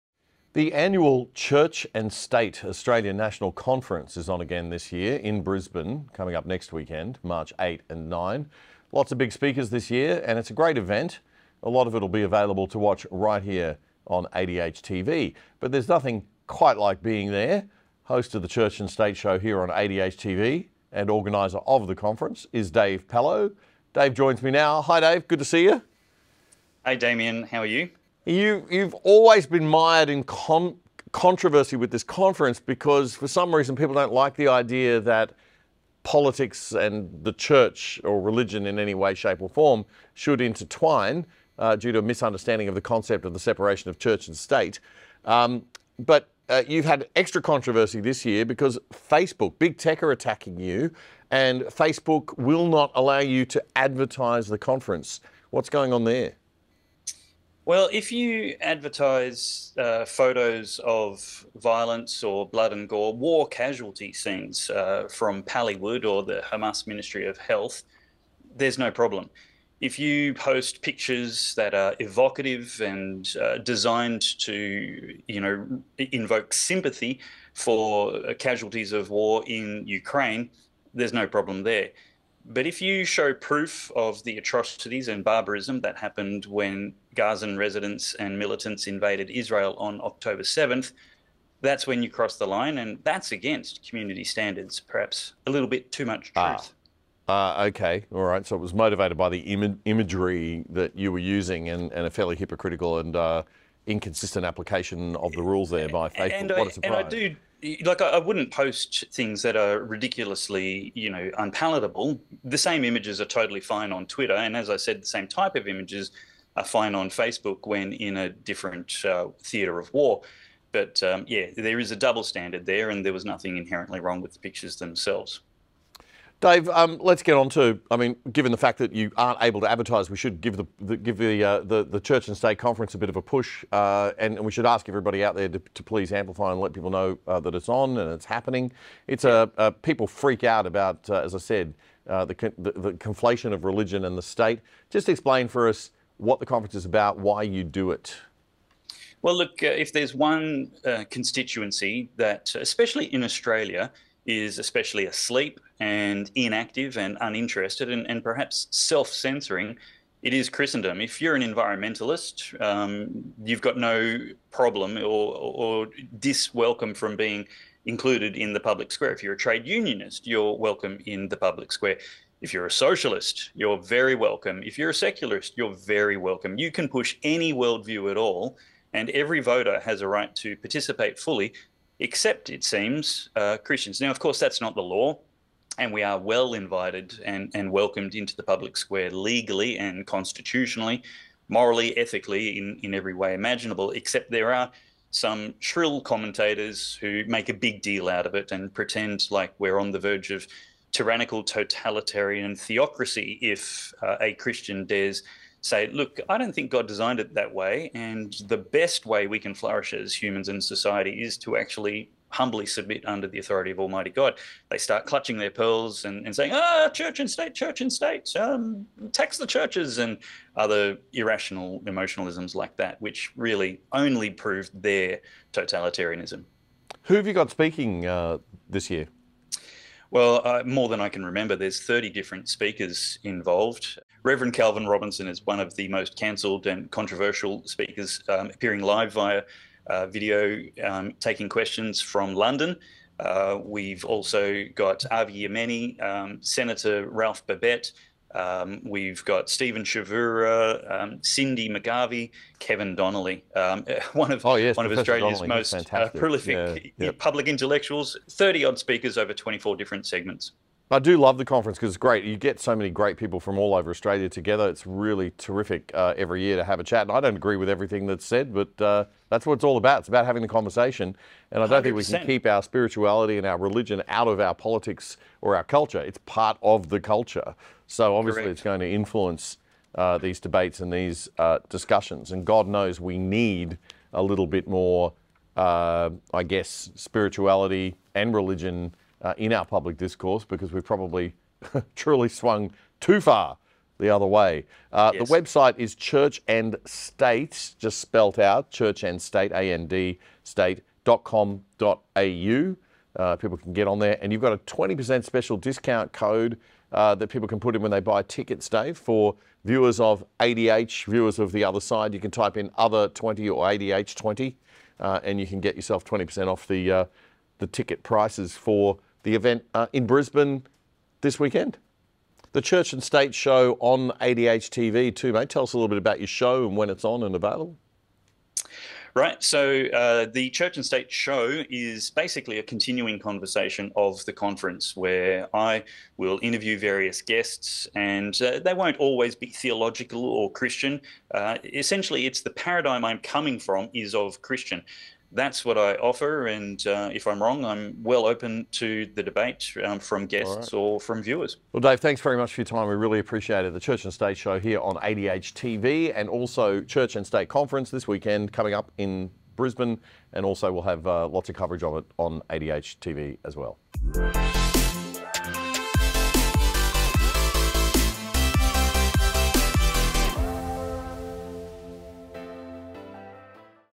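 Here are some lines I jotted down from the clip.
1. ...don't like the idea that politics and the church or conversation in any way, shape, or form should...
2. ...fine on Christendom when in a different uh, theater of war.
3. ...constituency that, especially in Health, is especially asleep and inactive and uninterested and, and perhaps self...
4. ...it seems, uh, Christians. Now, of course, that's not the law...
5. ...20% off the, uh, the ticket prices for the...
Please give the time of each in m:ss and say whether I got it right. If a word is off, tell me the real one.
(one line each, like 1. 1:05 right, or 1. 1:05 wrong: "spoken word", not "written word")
1. 0:33 wrong: "religion", not "conversation"
2. 1:56 wrong: "Facebook", not "Christendom"
3. 2:31 wrong: "Australia", not "Health"
4. 3:02 right
5. 5:16 right.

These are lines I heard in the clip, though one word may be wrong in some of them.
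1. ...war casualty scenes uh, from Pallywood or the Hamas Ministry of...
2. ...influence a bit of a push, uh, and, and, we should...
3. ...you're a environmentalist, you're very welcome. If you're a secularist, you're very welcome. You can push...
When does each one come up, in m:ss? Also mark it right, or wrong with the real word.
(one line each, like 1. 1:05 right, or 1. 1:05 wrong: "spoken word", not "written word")
1. 1:03 right
2. 2:12 wrong: "conference", not "influence"
3. 2:52 wrong: "socialist", not "environmentalist".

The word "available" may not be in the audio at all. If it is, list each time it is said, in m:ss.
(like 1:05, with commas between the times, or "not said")
0:12, 5:27.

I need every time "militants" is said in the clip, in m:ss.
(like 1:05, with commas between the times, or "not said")
1:28.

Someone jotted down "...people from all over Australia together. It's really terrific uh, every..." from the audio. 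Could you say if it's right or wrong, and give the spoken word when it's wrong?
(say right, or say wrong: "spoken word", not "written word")
right.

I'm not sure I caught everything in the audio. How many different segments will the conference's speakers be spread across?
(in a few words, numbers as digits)
24.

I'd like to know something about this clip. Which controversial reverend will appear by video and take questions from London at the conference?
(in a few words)
Calvin Robinson.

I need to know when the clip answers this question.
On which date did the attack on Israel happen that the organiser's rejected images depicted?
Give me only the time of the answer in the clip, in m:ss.
1:30.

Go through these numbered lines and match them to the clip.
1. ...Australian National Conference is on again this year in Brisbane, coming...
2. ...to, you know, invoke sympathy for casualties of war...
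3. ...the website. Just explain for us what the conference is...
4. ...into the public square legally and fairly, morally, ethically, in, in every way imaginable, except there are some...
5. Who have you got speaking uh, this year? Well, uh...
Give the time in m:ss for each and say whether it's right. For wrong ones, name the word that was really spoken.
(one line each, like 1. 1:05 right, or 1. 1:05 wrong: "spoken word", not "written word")
1. 0:02 right
2. 1:14 right
3. 2:24 wrong: "state", not "website"
4. 3:08 wrong: "constitutionally", not "fairly"
5. 3:47 right.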